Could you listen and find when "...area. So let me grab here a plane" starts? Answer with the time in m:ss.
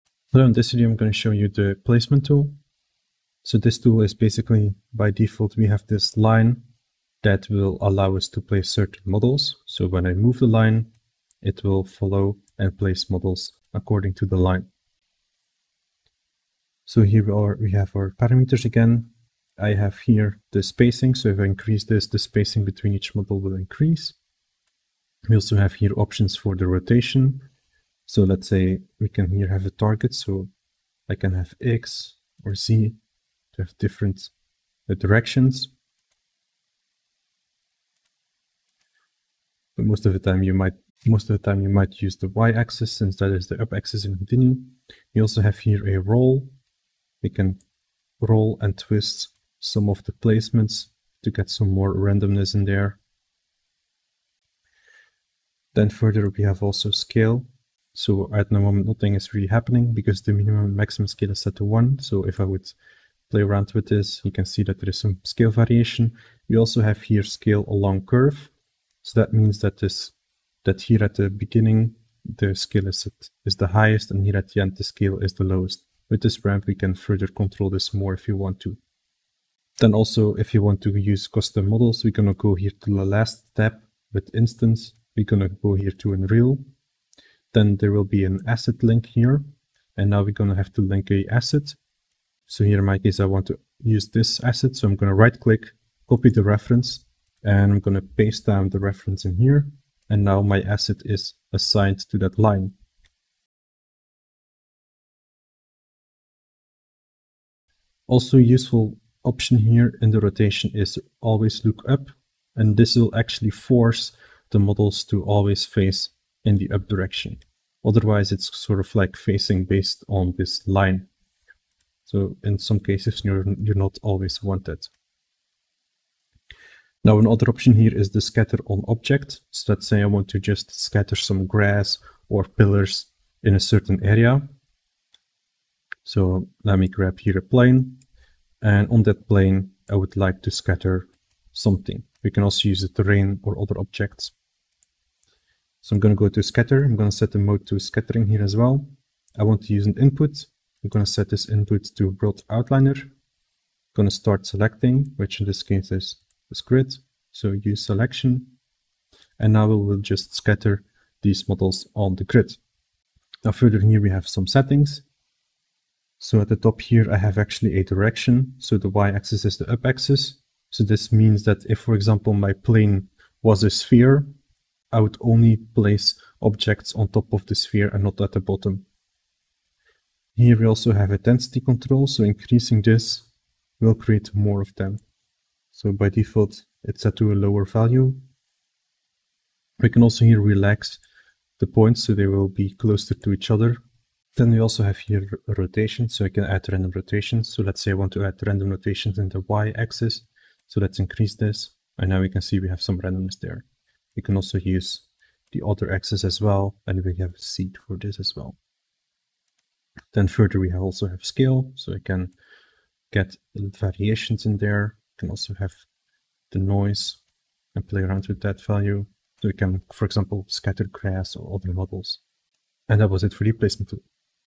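2:14.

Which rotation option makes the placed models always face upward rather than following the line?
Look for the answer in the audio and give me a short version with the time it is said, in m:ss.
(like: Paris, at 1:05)
always look up, at 1:51.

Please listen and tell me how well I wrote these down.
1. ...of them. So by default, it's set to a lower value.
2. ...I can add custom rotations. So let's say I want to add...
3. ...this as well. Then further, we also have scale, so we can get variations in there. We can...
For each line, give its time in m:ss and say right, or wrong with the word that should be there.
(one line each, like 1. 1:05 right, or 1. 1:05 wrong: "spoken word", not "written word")
1. 3:04 right
2. 3:16 wrong: "random", not "custom"
3. 3:27 right.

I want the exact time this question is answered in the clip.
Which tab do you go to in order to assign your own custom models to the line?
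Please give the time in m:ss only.
1:24.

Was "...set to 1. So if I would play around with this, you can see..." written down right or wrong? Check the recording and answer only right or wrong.
right.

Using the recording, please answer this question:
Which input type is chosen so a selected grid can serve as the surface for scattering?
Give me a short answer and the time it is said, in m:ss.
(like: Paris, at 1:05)
world outliner, at 2:32.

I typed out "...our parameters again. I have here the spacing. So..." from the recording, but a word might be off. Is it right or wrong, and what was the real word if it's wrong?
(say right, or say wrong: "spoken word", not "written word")
right.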